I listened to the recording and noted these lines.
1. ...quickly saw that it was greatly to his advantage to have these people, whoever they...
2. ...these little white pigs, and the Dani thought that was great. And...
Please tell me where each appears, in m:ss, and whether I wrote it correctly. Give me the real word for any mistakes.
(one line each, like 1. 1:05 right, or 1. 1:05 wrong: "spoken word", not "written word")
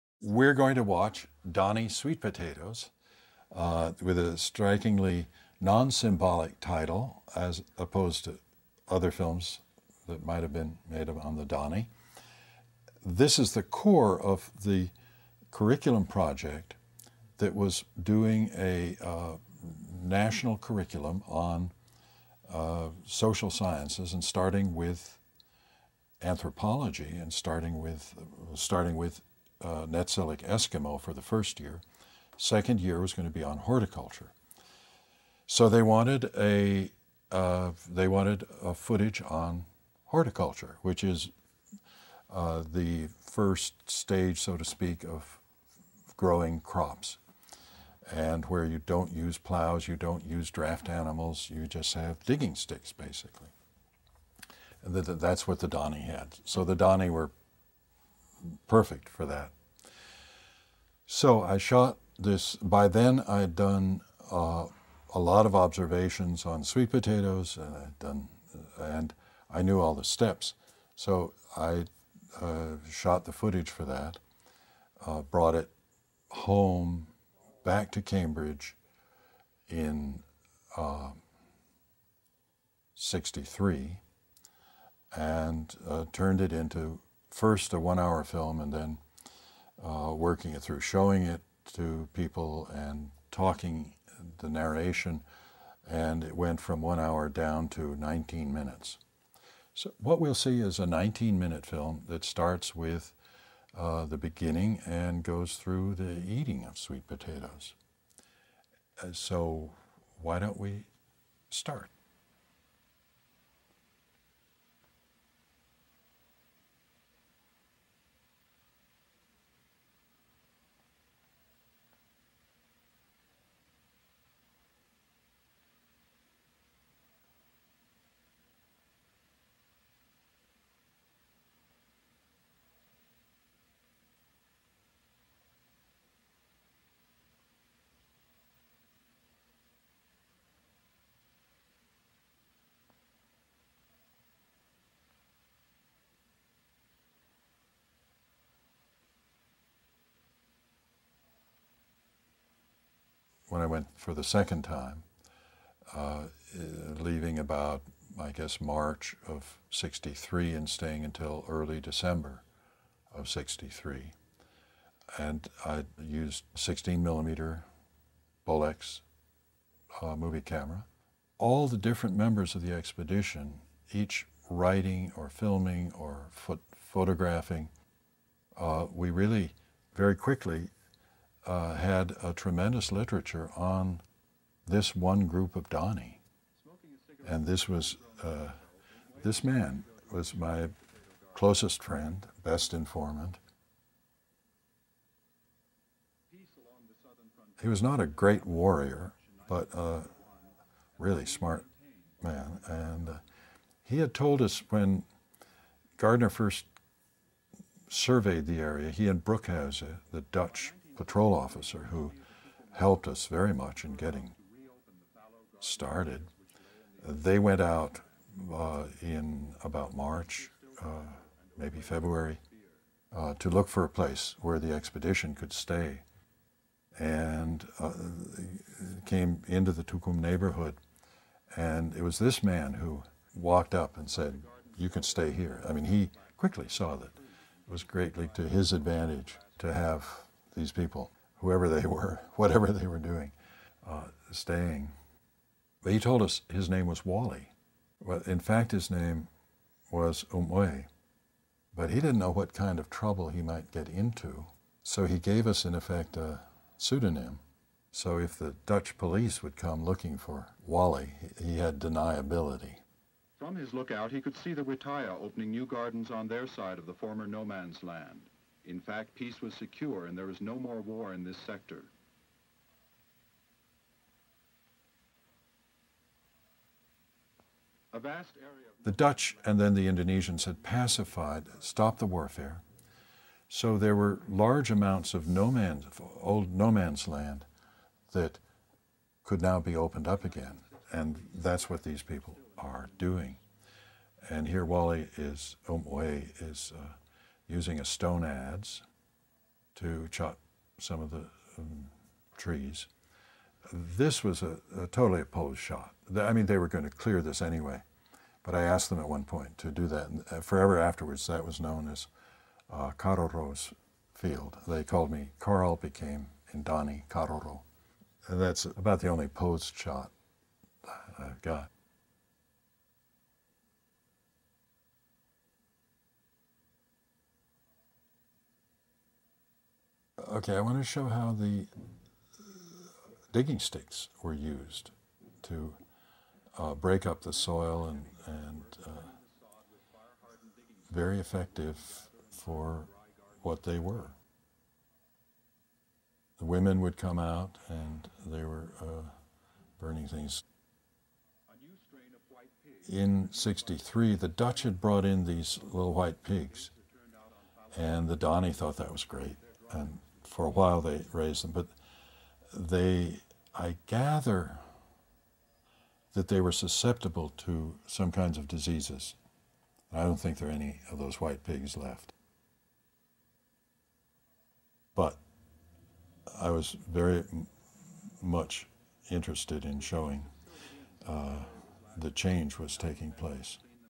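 1. 3:56 right
2. 5:55 right.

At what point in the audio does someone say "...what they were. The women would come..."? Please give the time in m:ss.
5:43.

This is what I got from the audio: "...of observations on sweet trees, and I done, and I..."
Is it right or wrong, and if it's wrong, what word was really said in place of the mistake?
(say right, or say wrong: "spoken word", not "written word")
wrong: "potatoes", not "trees".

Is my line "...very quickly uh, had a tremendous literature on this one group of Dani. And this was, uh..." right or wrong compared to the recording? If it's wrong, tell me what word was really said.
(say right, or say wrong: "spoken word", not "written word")
right.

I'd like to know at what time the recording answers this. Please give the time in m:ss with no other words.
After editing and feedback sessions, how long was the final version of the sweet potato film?
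1:37.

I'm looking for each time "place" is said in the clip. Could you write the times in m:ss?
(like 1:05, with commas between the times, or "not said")
3:43, 6:23.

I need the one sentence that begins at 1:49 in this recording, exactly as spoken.
Uh, so, why don't we start?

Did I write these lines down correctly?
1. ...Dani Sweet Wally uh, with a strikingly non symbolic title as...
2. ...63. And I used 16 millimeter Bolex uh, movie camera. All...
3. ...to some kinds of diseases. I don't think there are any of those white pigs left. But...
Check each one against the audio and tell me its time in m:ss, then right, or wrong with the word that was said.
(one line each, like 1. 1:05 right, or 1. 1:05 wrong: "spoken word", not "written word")
1. 0:01 wrong: "Potatoes", not "Wally"
2. 2:43 right
3. 6:07 right.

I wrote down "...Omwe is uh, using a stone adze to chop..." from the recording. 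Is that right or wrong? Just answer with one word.
right.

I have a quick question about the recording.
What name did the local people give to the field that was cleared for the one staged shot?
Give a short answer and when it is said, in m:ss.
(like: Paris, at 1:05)
Caroro's field, at 5:12.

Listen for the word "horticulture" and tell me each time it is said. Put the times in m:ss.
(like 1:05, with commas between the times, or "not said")
0:33, 0:40.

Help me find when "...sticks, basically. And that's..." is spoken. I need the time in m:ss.
0:52.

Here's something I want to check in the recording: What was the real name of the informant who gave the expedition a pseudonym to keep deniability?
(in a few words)
Umwe.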